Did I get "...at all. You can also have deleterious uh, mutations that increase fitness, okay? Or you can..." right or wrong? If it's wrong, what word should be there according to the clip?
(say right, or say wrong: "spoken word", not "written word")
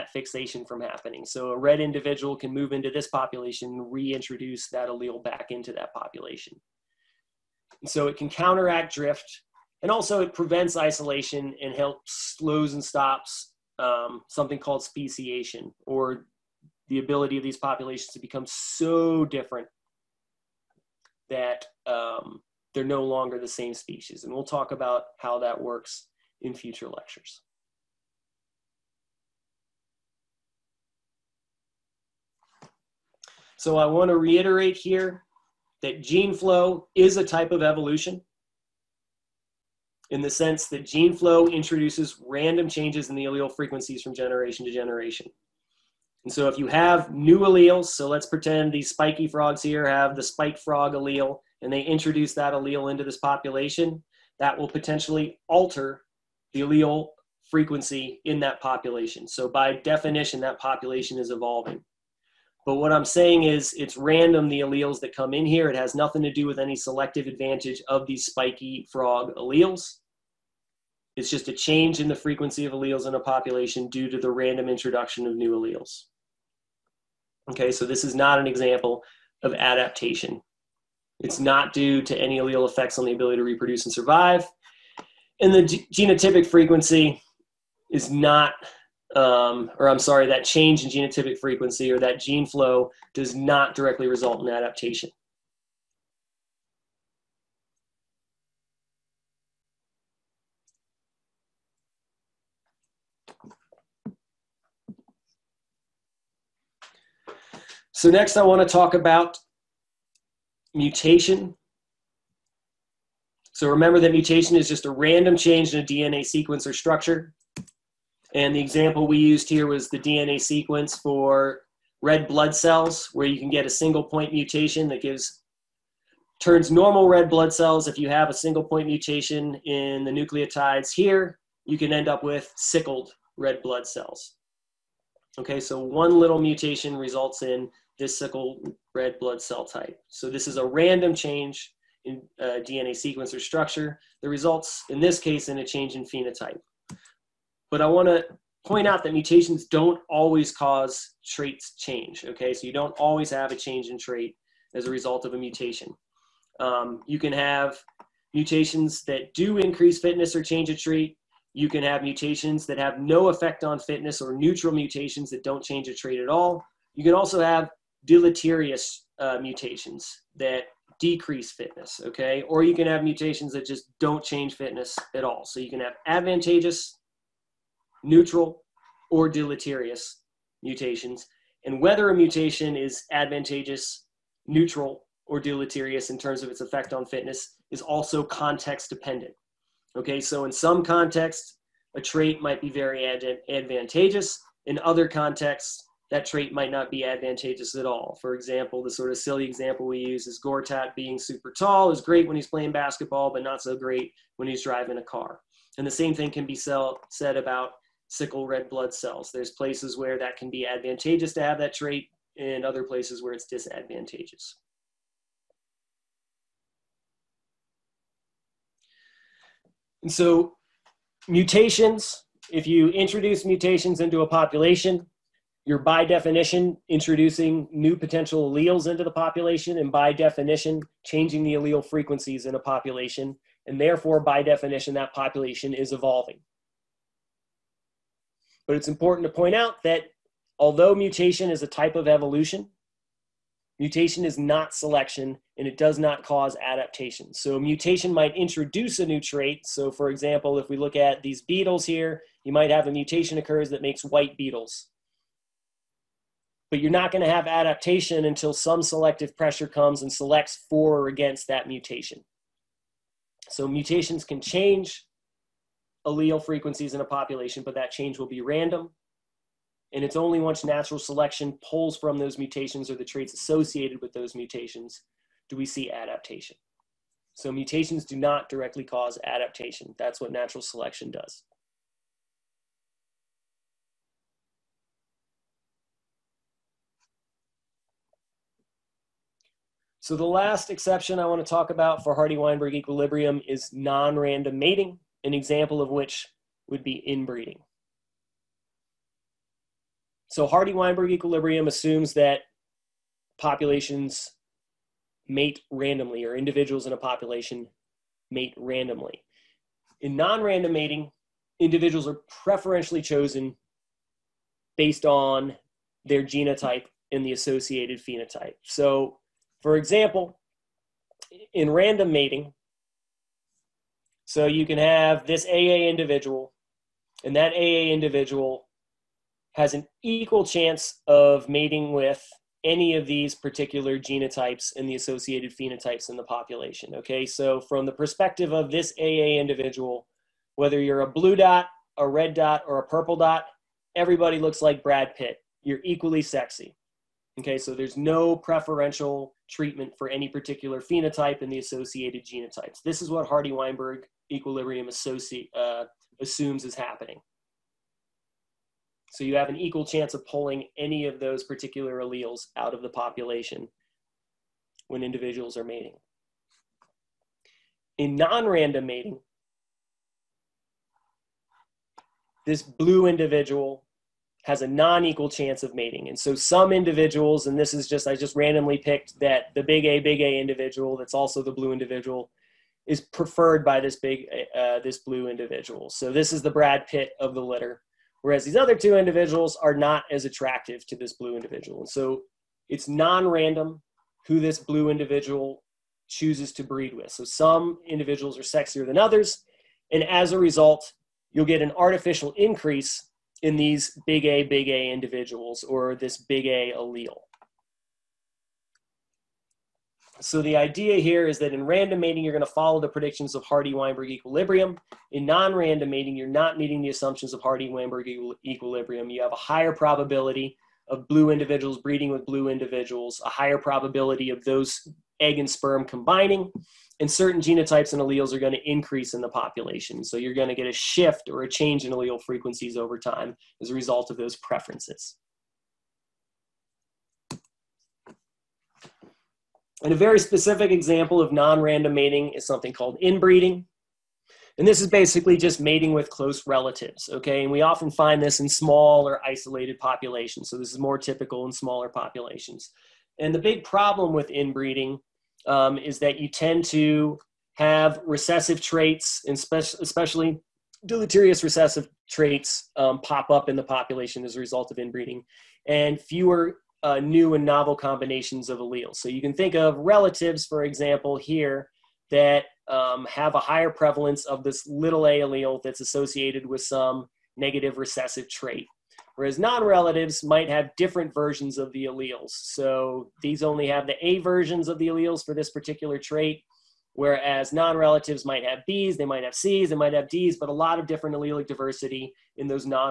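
wrong: "decrease", not "increase".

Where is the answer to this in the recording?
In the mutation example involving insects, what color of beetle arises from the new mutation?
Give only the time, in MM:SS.
04:14.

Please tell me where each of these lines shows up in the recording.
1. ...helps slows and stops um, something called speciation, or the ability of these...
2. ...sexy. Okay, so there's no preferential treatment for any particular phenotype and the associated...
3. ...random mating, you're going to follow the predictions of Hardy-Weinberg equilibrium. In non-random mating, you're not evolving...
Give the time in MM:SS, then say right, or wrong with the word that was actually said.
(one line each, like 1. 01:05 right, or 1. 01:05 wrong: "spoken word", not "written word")
1. 00:11 right
2. 05:46 right
3. 06:51 wrong: "meeting", not "evolving".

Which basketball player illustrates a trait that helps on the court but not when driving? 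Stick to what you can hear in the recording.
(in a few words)
Gortat.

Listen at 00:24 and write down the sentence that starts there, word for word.
And we'll talk about how that works in future lectures.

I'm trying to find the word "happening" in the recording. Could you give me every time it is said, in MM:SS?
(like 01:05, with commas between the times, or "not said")
00:00, 05:56.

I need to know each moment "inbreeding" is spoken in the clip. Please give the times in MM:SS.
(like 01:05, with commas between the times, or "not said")
04:57, 07:22, 07:34, 07:44.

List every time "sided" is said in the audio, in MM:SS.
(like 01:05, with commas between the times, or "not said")
not said.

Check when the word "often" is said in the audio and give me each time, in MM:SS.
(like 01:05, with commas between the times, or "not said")
07:27.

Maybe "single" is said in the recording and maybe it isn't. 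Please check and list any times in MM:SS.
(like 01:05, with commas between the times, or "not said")
02:03, 02:08.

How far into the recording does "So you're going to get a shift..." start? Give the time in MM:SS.
07:10.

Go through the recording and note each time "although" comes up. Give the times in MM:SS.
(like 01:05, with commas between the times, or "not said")
04:00.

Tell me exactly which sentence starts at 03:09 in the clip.
Okay, so in some contexts, a trait might be very ad- advantageous.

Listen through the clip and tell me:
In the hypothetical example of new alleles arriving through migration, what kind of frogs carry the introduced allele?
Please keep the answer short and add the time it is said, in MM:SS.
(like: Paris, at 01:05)
spiky frogs, at 00:48.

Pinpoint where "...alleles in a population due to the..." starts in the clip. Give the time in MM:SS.
01:12.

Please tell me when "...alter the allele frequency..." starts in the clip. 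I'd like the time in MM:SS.
00:55.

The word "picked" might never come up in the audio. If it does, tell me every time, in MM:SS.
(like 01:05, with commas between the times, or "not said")
06:18.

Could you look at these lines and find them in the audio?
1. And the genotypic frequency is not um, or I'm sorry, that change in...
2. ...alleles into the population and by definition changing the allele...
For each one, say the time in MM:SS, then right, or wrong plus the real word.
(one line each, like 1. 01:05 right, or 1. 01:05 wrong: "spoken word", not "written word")
1. 01:25 right
2. 03:48 right.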